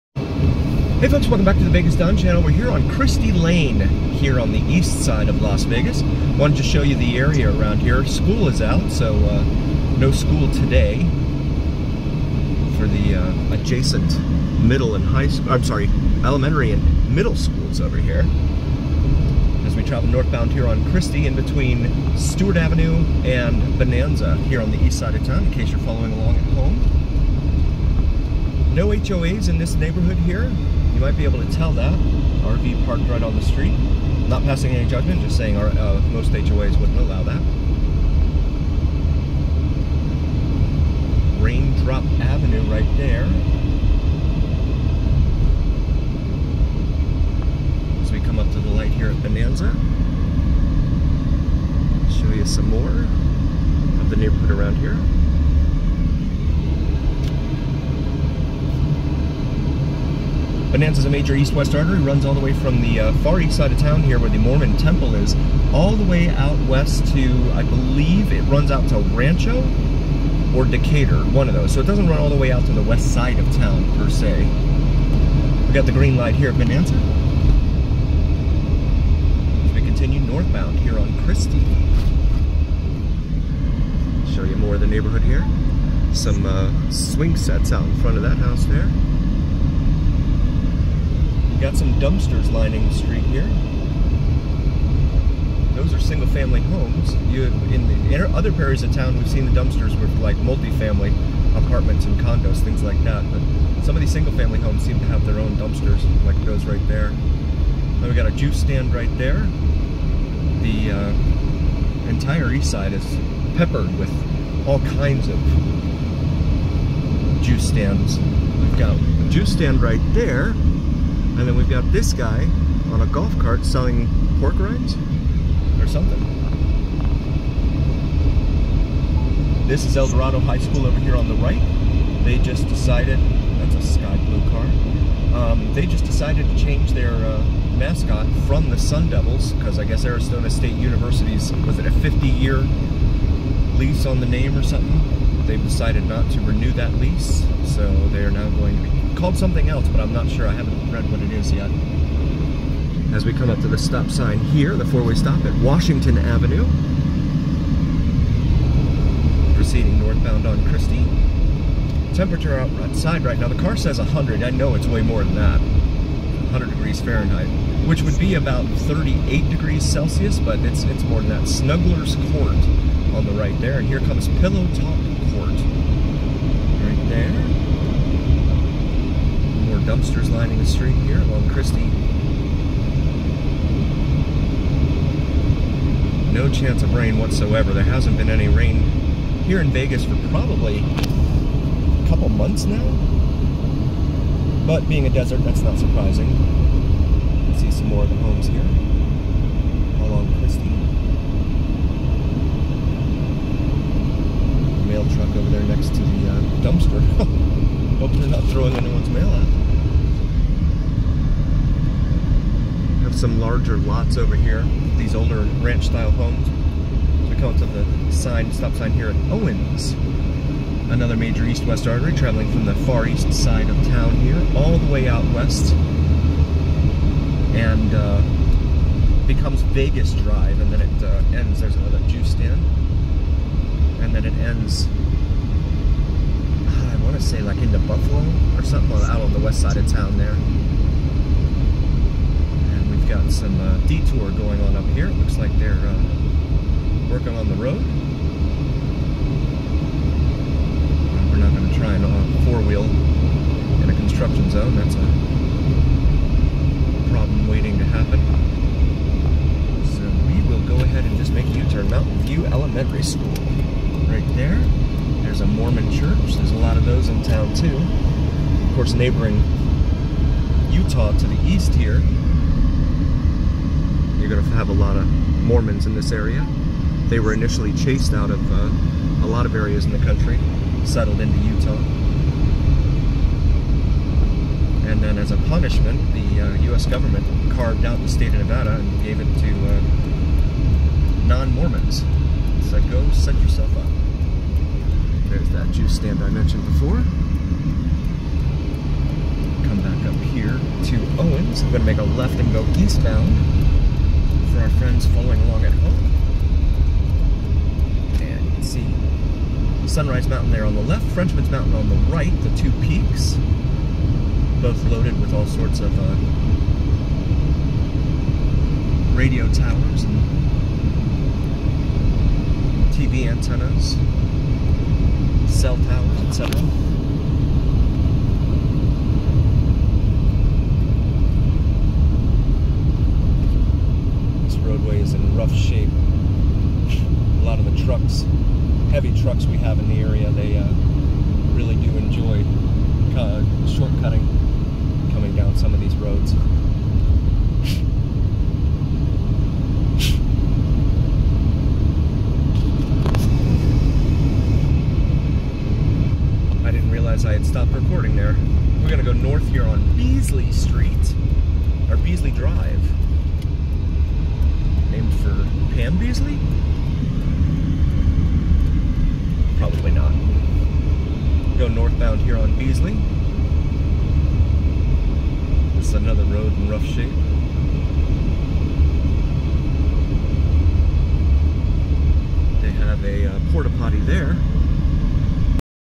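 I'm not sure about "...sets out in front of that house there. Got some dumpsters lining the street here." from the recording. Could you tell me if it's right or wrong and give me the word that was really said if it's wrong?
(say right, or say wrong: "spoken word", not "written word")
right.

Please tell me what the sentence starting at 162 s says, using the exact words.
Temperature outside right now, the car says 100.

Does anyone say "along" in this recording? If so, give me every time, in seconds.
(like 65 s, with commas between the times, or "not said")
26 s, 181 s, 200 s, 305 s.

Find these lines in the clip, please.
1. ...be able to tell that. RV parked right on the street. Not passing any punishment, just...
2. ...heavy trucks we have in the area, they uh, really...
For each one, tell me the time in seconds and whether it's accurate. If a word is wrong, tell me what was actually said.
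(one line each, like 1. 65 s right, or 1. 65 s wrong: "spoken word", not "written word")
1. 31 s wrong: "judgment", not "punishment"
2. 338 s right.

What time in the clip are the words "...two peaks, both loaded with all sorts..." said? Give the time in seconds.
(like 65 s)
312 s.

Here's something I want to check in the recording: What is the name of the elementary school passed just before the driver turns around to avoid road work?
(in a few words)
Mountain View Elementary School.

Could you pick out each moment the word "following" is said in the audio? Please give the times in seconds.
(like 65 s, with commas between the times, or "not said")
25 s, 305 s.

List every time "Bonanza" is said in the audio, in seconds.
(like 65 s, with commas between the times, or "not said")
23 s, 49 s, 60 s, 76 s.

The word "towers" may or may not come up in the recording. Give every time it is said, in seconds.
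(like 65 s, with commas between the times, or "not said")
319 s, 325 s.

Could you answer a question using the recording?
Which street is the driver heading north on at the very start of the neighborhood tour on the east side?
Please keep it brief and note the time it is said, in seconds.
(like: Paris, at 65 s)
Christy Lane, at 2 s.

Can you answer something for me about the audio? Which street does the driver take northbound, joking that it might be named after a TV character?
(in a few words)
Beasley Street.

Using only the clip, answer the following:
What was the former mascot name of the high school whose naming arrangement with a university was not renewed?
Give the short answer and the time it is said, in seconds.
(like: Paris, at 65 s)
Sun Devils, at 138 s.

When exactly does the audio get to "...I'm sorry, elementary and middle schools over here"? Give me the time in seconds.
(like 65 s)
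15 s.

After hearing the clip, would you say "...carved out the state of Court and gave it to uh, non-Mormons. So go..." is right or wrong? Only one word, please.
wrong.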